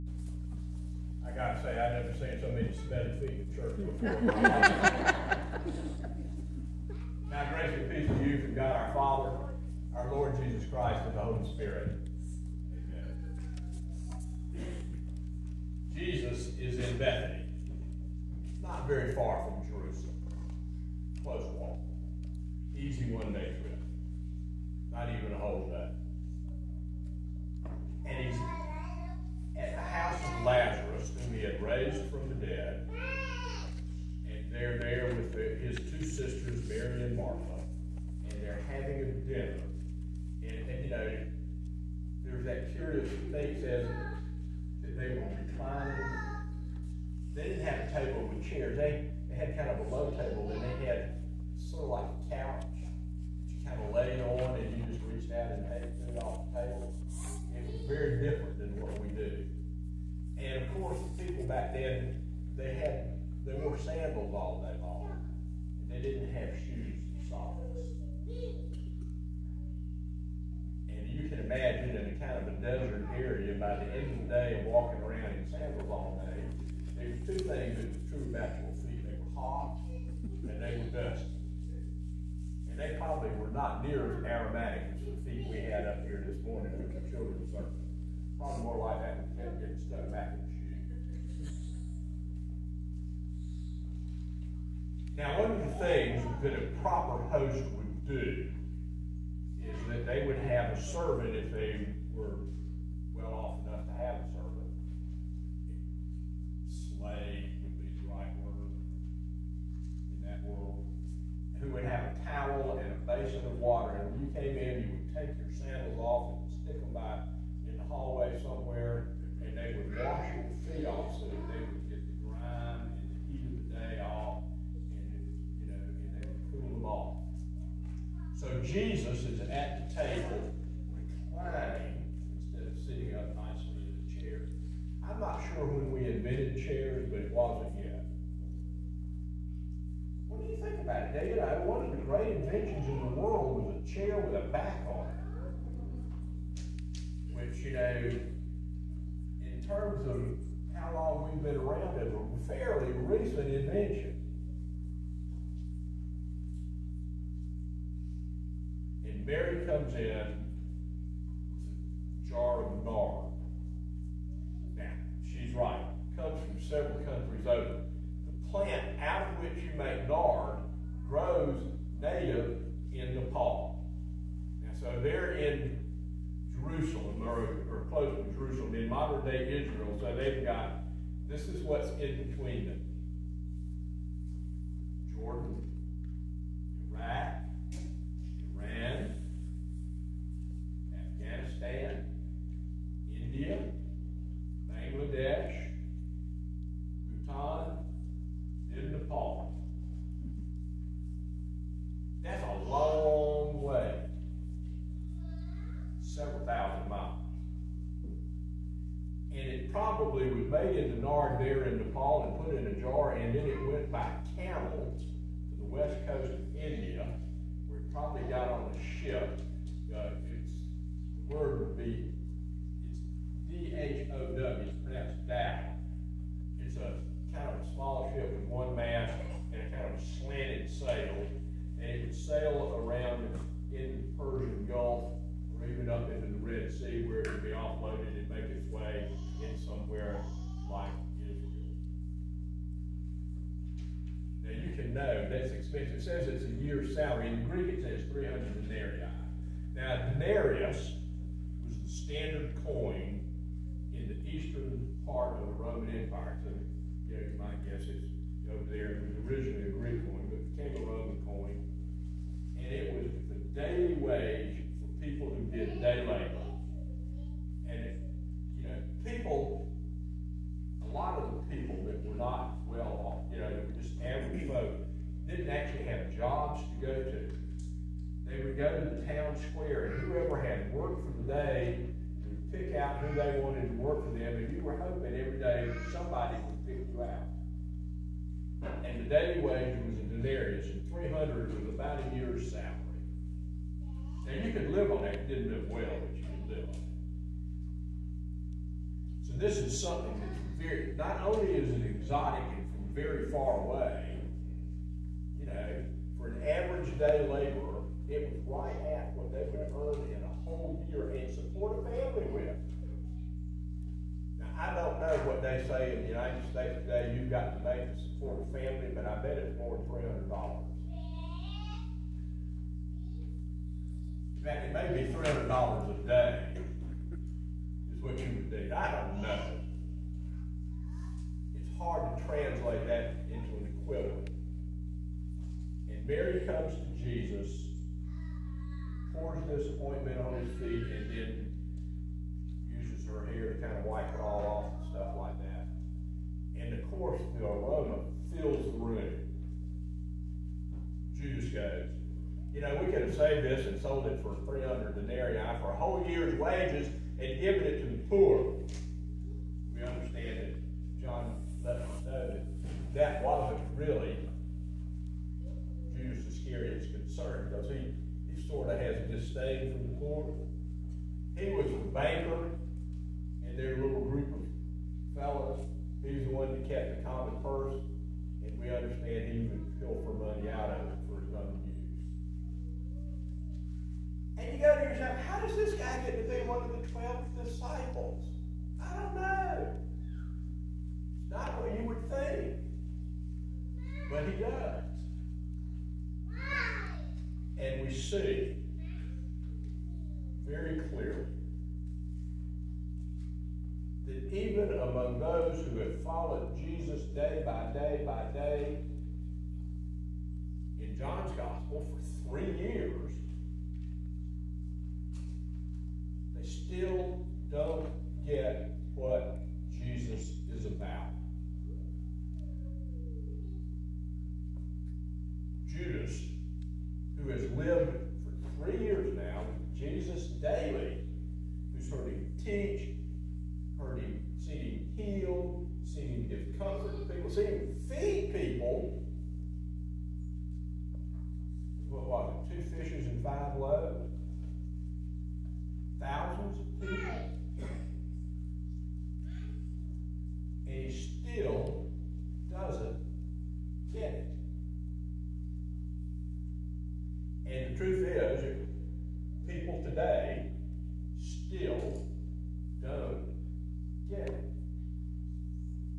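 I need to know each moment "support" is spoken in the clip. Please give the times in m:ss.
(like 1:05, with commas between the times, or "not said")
5:11, 5:18.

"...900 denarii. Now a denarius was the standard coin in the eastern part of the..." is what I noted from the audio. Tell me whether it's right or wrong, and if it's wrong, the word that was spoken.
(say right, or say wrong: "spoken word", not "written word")
wrong: "300", not "900".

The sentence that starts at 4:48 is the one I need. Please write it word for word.
And the daily wage was a denarius, and 300 was about a now you could live on that.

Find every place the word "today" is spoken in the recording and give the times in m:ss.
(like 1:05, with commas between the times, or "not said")
5:16, 7:39.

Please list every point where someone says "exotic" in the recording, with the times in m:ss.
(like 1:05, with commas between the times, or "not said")
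5:01.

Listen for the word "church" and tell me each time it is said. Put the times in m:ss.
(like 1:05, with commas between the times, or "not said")
0:03.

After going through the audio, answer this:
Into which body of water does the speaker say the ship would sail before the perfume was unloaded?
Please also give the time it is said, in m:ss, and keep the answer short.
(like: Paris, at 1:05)
Red Sea, at 3:56.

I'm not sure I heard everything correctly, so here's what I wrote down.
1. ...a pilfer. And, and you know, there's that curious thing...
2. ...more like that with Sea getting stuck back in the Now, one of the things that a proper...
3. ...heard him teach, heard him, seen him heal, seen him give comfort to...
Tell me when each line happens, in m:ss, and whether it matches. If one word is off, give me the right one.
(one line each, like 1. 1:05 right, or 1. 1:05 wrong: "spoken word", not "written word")
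1. 0:39 wrong: "dinner", not "pilfer"
2. 1:28 wrong: "Ken", not "Sea"
3. 7:11 right.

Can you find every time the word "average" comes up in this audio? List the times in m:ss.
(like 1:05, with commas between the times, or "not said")
4:34, 5:06.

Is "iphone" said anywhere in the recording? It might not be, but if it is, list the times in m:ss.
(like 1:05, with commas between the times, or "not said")
not said.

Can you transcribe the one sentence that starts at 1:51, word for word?
Who would have a towel and a basin of water.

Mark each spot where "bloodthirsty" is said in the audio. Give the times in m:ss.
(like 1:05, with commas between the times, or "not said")
not said.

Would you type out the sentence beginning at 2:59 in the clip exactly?
So they've got, this is what's in between them.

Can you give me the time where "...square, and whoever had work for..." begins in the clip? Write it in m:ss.
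4:39.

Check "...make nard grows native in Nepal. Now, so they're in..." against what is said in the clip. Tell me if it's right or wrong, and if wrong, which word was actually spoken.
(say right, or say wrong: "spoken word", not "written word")
right.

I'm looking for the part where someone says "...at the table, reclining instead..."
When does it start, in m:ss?
2:09.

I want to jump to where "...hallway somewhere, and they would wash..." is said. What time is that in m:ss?
1:57.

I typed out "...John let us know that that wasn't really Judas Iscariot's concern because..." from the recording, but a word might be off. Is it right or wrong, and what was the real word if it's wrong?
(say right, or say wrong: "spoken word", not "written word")
right.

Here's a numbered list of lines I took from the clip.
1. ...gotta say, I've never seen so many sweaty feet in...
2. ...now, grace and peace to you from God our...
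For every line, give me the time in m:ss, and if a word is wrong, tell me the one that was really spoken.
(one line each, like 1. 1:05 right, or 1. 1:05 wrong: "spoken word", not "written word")
1. 0:01 right
2. 0:07 right.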